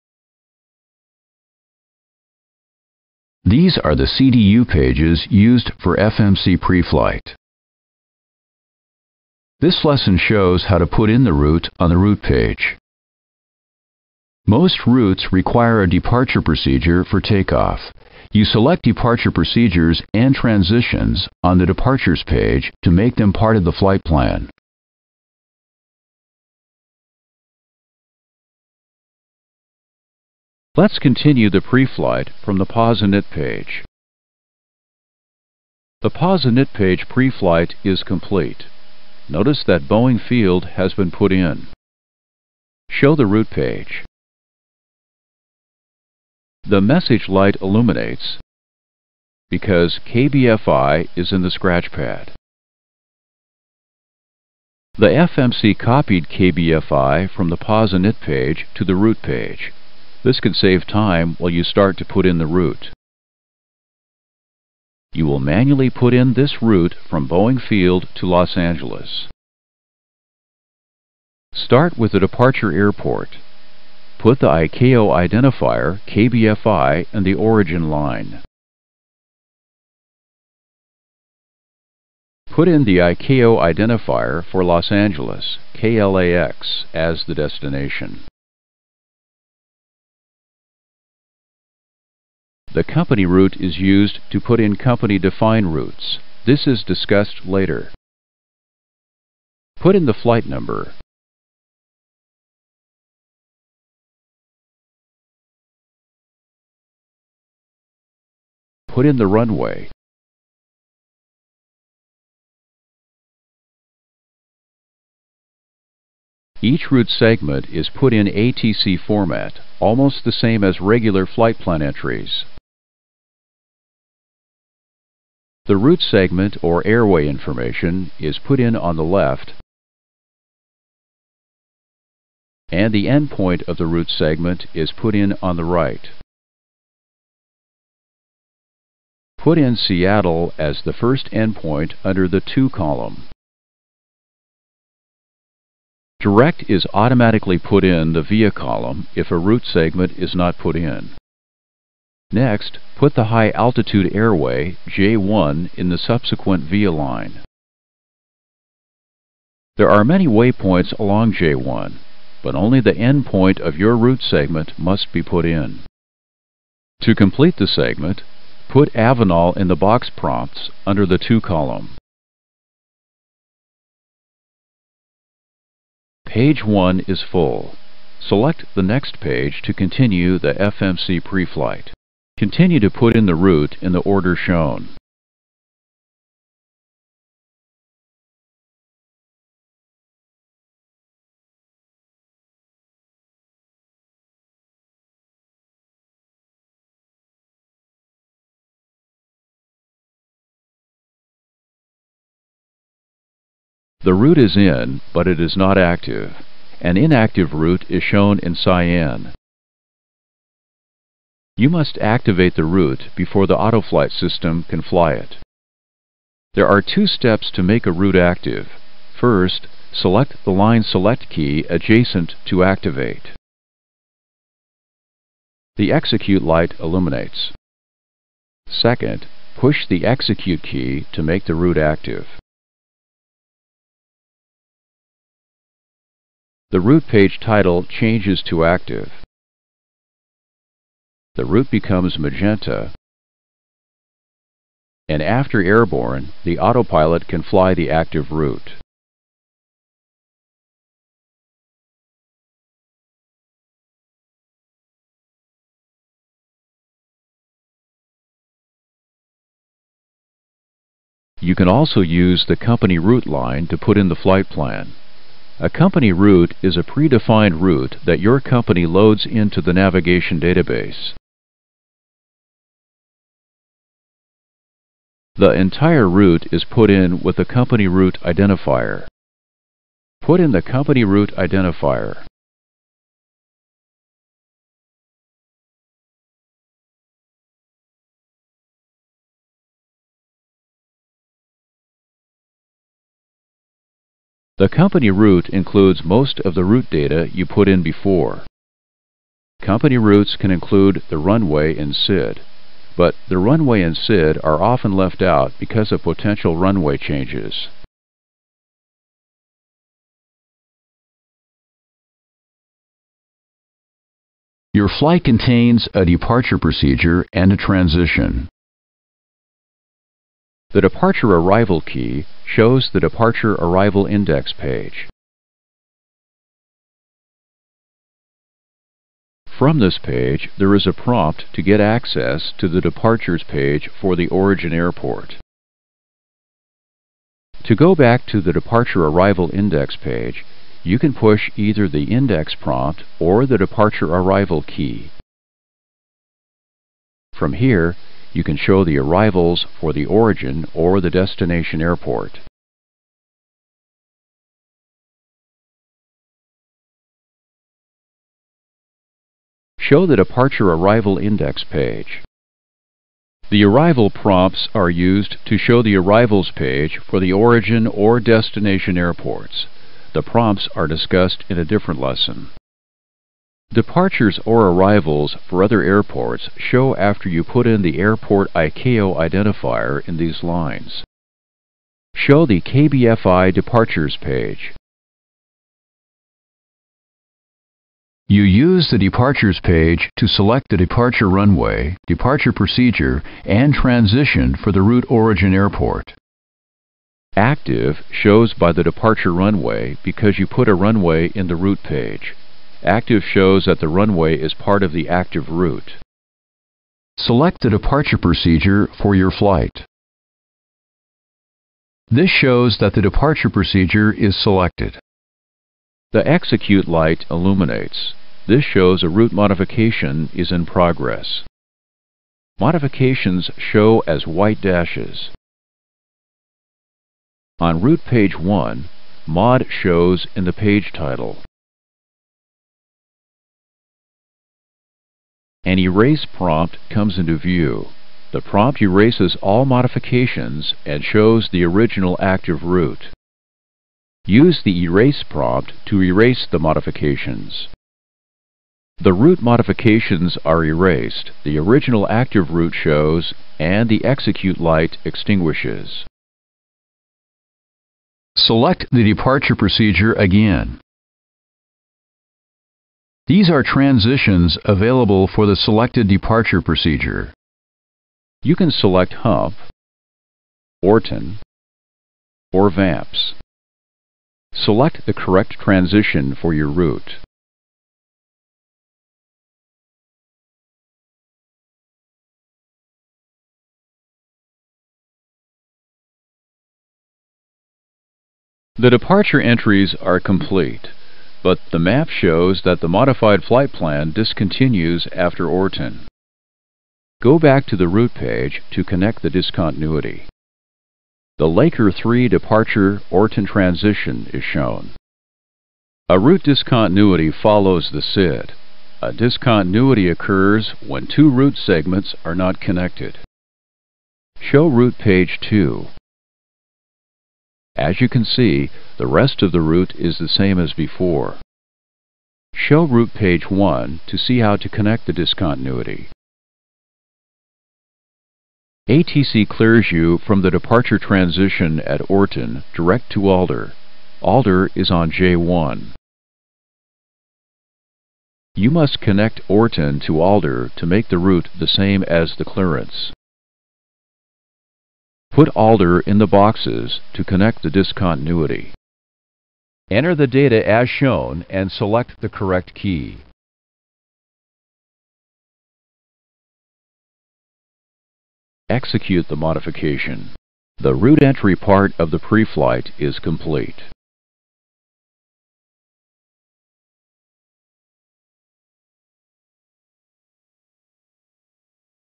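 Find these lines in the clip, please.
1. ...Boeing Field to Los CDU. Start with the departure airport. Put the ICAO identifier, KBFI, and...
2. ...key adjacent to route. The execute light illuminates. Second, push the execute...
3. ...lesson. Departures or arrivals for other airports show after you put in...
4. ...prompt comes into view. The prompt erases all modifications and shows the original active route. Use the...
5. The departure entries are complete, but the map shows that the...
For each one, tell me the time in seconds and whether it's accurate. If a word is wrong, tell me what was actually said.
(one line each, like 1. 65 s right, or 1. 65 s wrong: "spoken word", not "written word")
1. 67 s wrong: "Angeles", not "CDU"
2. 221 s wrong: "activate", not "route"
3. 371 s right
4. 436 s right
5. 488 s right.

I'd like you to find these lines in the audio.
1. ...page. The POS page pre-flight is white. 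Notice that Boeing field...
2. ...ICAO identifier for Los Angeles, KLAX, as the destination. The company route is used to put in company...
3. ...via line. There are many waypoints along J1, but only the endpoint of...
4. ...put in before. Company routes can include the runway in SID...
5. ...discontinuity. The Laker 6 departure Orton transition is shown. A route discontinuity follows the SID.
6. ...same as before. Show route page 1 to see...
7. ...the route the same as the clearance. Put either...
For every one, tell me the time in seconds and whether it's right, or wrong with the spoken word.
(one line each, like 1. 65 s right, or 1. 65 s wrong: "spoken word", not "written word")
1. 33 s wrong: "complete", not "white"
2. 82 s right
3. 156 s right
4. 297 s right
5. 499 s wrong: "3", not "6"
6. 520 s right
7. 541 s wrong: "alder", not "either".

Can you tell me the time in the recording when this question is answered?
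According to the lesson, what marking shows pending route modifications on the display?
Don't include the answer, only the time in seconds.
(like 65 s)
424 s.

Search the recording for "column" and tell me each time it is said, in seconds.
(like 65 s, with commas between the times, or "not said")
142 s, 148 s, 171 s.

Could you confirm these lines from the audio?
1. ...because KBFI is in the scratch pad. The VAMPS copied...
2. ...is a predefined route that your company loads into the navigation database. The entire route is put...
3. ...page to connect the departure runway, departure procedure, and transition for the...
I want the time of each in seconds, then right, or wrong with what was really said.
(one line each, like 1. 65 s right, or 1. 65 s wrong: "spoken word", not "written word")
1. 49 s wrong: "FMC", not "VAMPS"
2. 266 s right
3. 389 s wrong: "select", not "connect".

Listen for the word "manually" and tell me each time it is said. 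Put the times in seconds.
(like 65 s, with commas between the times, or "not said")
65 s.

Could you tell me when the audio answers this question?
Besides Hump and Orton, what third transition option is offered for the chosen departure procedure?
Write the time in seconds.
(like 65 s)
472 s.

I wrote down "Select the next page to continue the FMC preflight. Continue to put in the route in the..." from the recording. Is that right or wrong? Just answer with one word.
right.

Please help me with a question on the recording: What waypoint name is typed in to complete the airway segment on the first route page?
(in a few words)
Avenal.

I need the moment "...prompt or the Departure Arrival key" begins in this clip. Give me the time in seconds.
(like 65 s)
342 s.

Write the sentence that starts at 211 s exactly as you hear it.
You must activate the route before the autoflight system can fly it.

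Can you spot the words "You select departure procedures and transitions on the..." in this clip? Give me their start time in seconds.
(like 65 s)
18 s.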